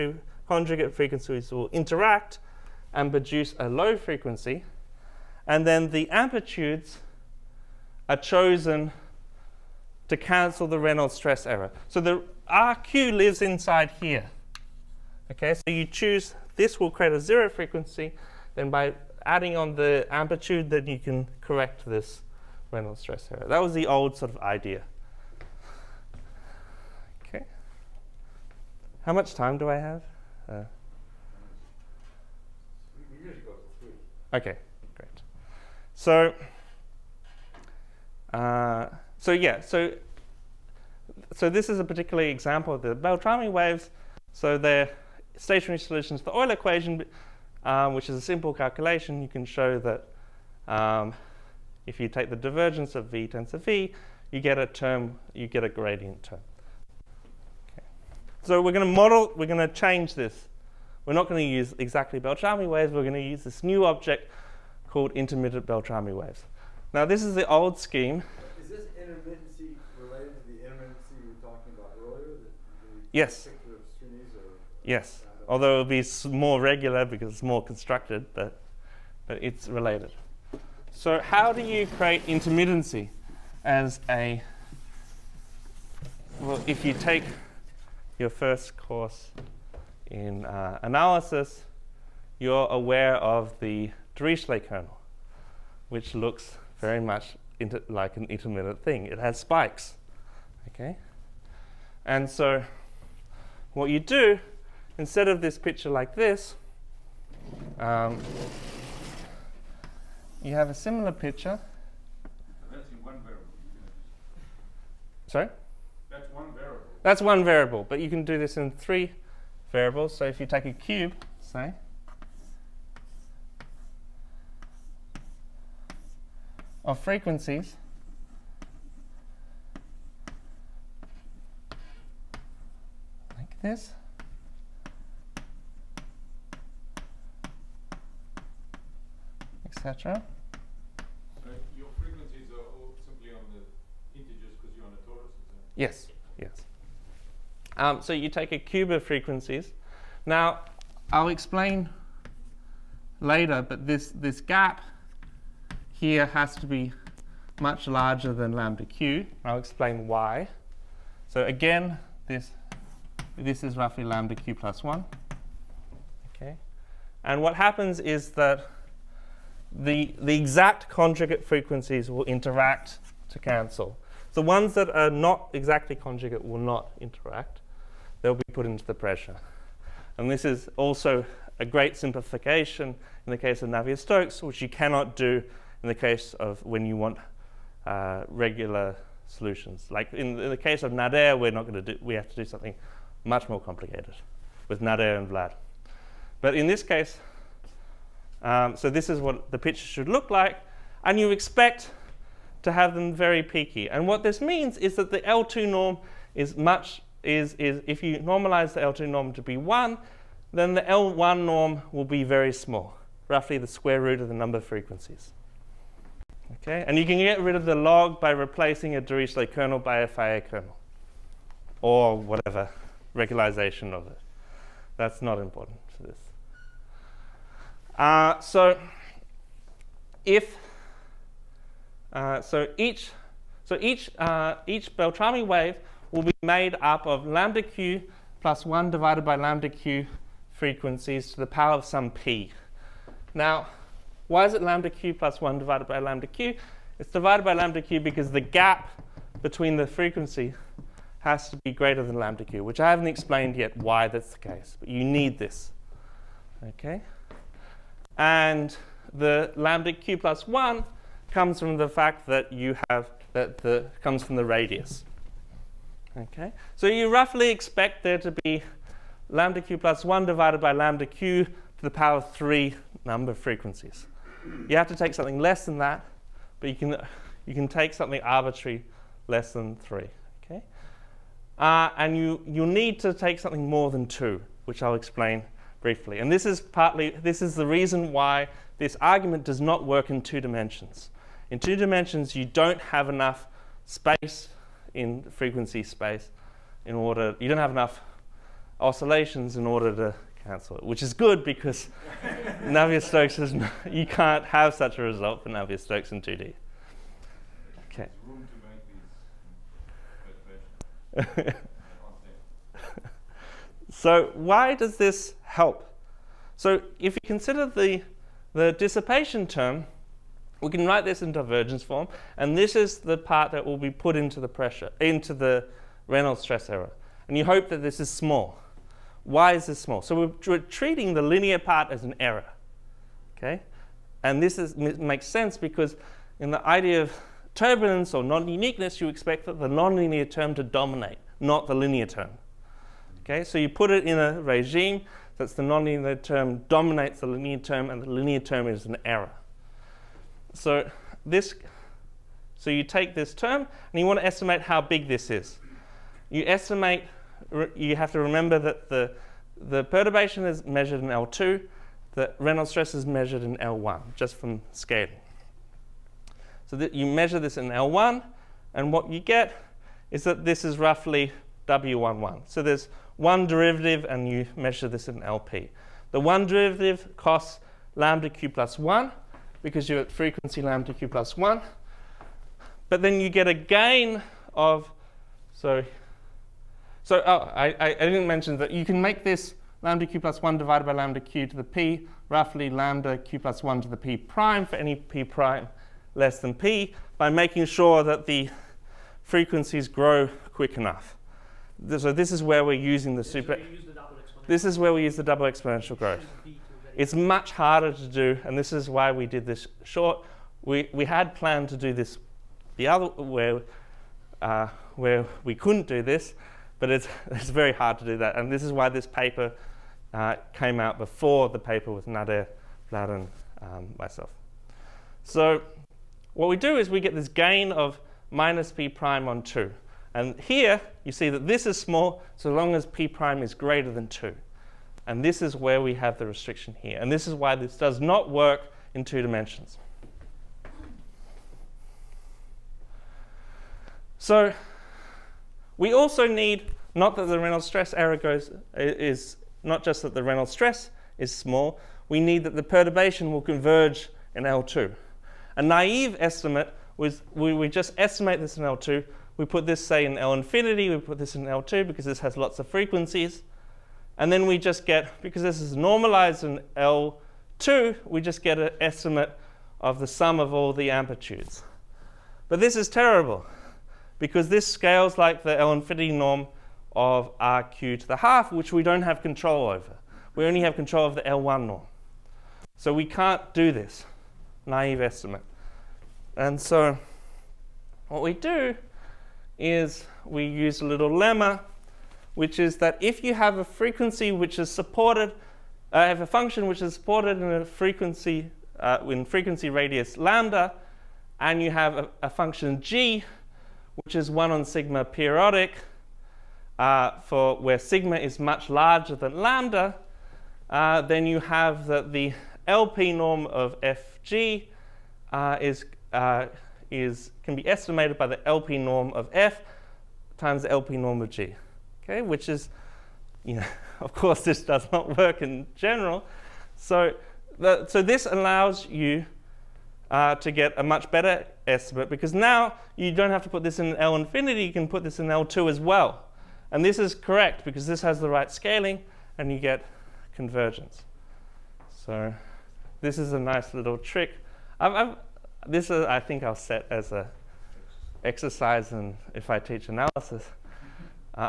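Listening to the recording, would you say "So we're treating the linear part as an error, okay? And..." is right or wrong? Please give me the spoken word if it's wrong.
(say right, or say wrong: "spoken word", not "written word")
right.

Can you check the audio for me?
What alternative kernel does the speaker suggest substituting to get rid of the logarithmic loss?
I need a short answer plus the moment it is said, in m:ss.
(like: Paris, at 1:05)
Fejér kernel, at 3:40.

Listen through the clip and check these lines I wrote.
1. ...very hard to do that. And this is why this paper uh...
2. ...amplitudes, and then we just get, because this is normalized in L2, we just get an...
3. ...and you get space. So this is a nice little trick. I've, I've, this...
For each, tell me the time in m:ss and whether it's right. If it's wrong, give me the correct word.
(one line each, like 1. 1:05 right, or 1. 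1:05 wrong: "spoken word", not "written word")
1. 6:57 right
2. 7:42 wrong: "frequencies", not "amplitudes"
3. 8:59 wrong: "convergence", not "space".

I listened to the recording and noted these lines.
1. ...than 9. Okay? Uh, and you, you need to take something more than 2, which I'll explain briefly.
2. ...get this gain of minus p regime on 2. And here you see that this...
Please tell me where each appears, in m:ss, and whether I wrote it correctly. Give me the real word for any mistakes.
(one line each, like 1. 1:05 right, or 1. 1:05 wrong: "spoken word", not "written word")
1. 4:39 wrong: "3", not "9"
2. 7:06 wrong: "prime", not "regime".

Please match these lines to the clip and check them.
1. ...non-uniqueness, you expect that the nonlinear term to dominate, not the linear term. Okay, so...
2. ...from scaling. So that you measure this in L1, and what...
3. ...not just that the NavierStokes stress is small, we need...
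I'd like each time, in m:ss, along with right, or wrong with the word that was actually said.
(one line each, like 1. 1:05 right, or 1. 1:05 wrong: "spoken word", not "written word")
1. 5:38 right
2. 6:04 right
3. 7:29 wrong: "Reynolds", not "NavierStokes".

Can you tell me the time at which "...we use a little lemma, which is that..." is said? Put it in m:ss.
8:10.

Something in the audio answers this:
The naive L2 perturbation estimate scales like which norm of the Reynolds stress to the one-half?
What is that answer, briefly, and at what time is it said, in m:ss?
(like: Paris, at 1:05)
L-infinity norm, at 7:55.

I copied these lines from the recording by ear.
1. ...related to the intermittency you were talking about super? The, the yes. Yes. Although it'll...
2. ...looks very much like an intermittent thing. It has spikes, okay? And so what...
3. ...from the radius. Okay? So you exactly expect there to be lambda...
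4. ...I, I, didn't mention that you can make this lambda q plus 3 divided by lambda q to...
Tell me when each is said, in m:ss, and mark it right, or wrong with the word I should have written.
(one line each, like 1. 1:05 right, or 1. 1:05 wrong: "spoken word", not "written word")
1. 1:09 wrong: "earlier", not "super"
2. 1:36 right
3. 4:24 wrong: "roughly", not "exactly"
4. 6:27 wrong: "1", not "3".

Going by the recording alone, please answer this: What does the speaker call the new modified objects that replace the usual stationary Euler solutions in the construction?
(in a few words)
intermittent Beltrami waves.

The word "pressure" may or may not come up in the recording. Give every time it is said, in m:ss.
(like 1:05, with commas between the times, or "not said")
2:58, 5:24.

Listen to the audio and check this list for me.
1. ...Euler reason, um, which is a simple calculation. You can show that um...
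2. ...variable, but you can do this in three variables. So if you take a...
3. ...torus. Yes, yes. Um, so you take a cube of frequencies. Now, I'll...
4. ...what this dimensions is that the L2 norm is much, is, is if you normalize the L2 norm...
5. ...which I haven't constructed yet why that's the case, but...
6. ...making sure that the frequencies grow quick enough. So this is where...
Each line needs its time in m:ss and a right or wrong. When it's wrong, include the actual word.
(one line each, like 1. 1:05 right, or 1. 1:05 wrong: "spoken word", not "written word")
1. 0:46 wrong: "equation", not "reason"
2. 1:57 right
3. 2:25 right
4. 3:24 wrong: "means", not "dimensions"
5. 4:12 wrong: "explained", not "constructed"
6. 6:37 right.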